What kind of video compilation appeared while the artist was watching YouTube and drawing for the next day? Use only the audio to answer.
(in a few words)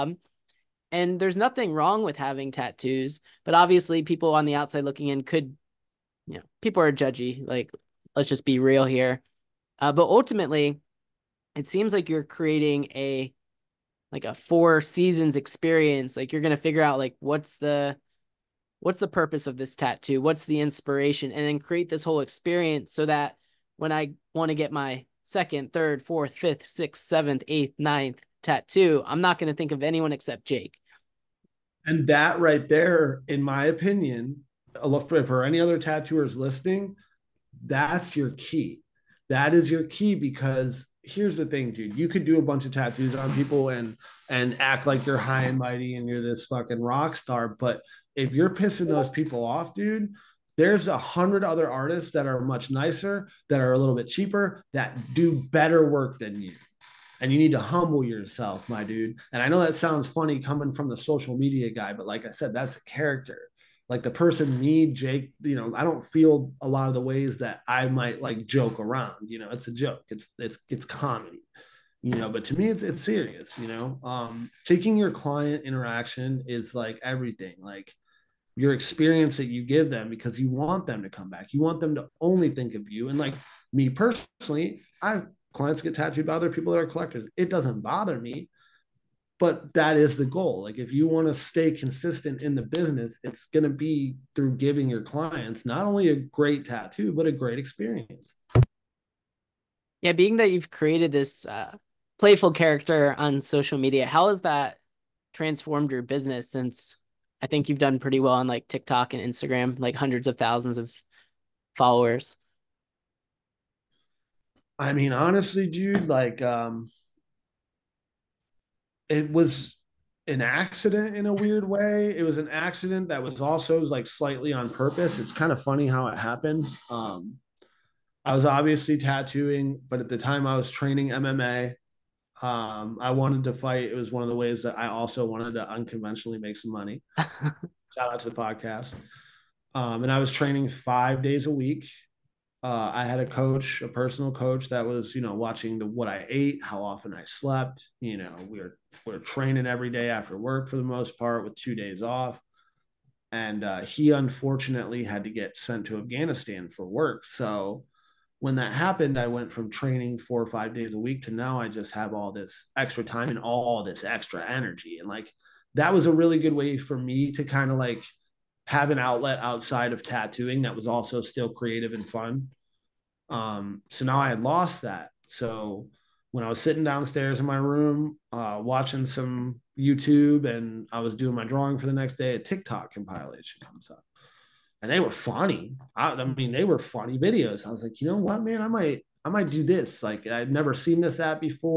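TikTok compilation.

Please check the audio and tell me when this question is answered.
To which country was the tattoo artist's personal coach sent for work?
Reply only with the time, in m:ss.
2:35.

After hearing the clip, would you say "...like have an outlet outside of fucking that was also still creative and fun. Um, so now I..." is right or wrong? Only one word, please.
wrong.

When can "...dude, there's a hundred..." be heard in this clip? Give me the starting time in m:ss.
0:49.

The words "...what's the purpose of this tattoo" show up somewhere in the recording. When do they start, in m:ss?
0:18.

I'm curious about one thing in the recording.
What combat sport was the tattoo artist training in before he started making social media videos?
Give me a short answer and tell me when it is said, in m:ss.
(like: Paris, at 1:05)
MMA, at 2:11.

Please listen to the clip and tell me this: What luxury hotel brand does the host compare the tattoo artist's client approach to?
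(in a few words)
Four Seasons.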